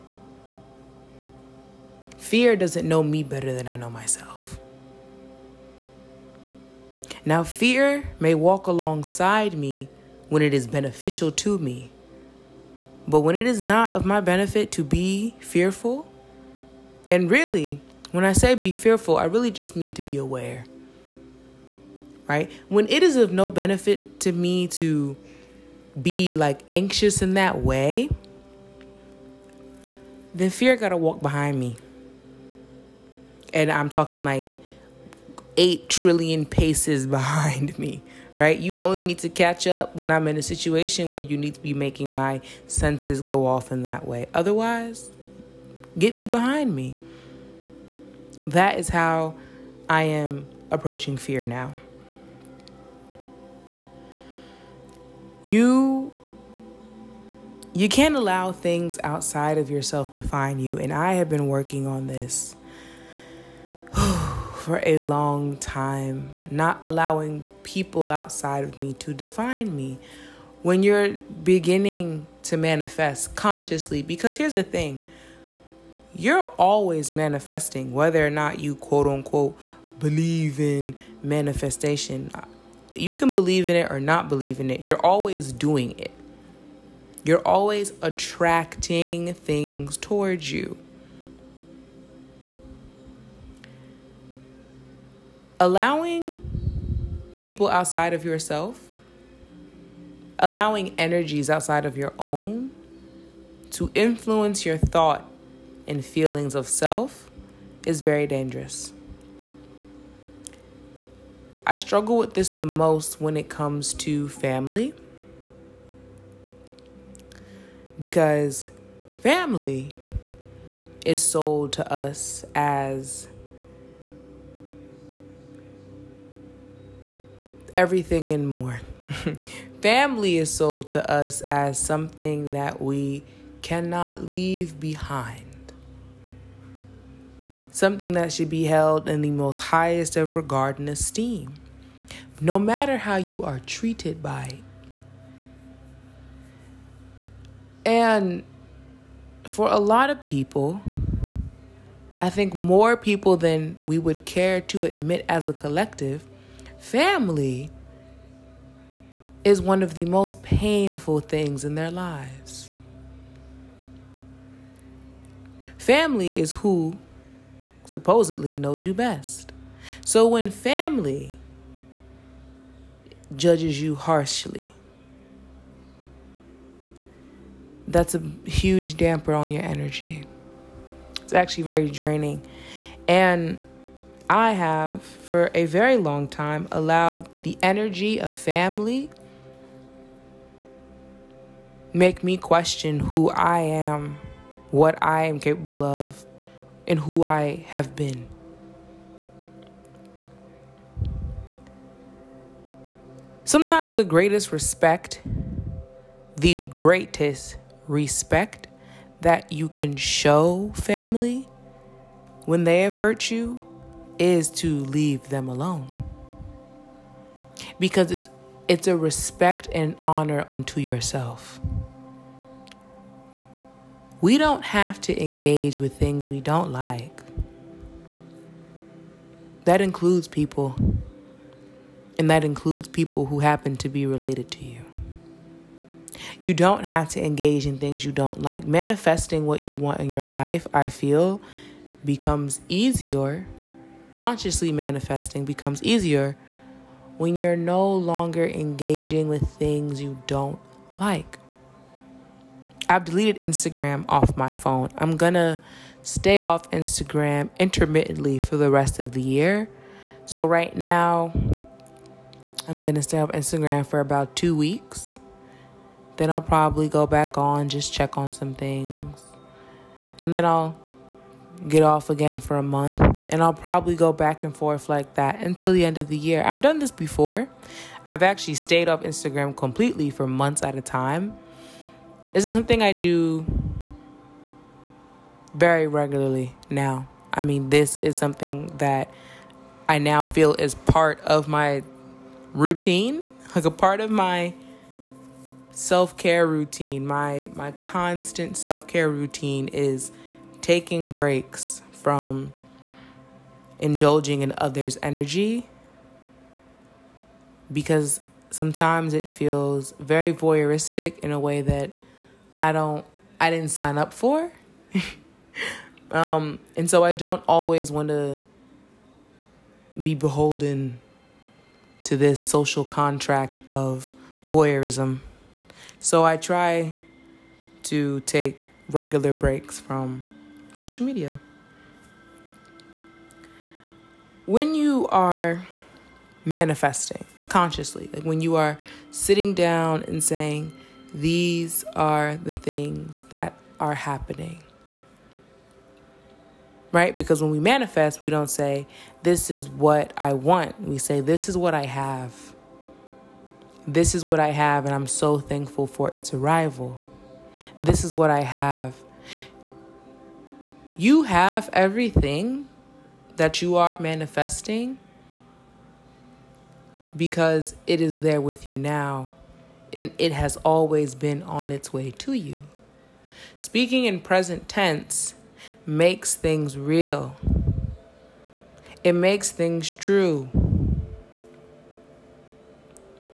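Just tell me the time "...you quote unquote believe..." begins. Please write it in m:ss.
1:18.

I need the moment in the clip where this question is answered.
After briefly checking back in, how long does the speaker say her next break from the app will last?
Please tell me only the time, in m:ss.
4:32.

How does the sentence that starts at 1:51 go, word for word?
I struggle with this the most when it comes to family because family is sold to us as everything and more.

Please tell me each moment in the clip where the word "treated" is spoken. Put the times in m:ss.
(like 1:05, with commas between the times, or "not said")
2:23.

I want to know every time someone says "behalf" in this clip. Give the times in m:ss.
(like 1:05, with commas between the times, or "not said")
not said.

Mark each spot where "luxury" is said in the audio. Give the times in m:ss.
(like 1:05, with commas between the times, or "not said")
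not said.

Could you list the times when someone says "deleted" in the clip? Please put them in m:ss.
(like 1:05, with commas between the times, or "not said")
4:13.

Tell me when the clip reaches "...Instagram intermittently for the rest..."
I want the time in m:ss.
4:16.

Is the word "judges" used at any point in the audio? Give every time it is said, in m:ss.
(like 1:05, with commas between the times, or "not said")
2:53.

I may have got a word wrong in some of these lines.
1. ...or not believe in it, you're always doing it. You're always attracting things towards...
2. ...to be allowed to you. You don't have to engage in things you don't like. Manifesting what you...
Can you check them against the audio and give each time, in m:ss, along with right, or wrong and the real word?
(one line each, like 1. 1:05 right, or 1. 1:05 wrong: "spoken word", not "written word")
1. 1:23 right
2. 3:53 wrong: "related", not "allowed".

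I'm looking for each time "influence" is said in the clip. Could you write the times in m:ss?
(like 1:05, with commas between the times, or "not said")
1:43.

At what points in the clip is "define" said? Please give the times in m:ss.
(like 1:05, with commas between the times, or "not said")
1:00, 1:09.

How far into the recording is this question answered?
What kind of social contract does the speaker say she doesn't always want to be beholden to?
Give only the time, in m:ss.
5:24.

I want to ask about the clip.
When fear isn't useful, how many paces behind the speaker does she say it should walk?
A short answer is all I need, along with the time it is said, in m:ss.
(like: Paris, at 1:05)
8 trillion, at 0:35.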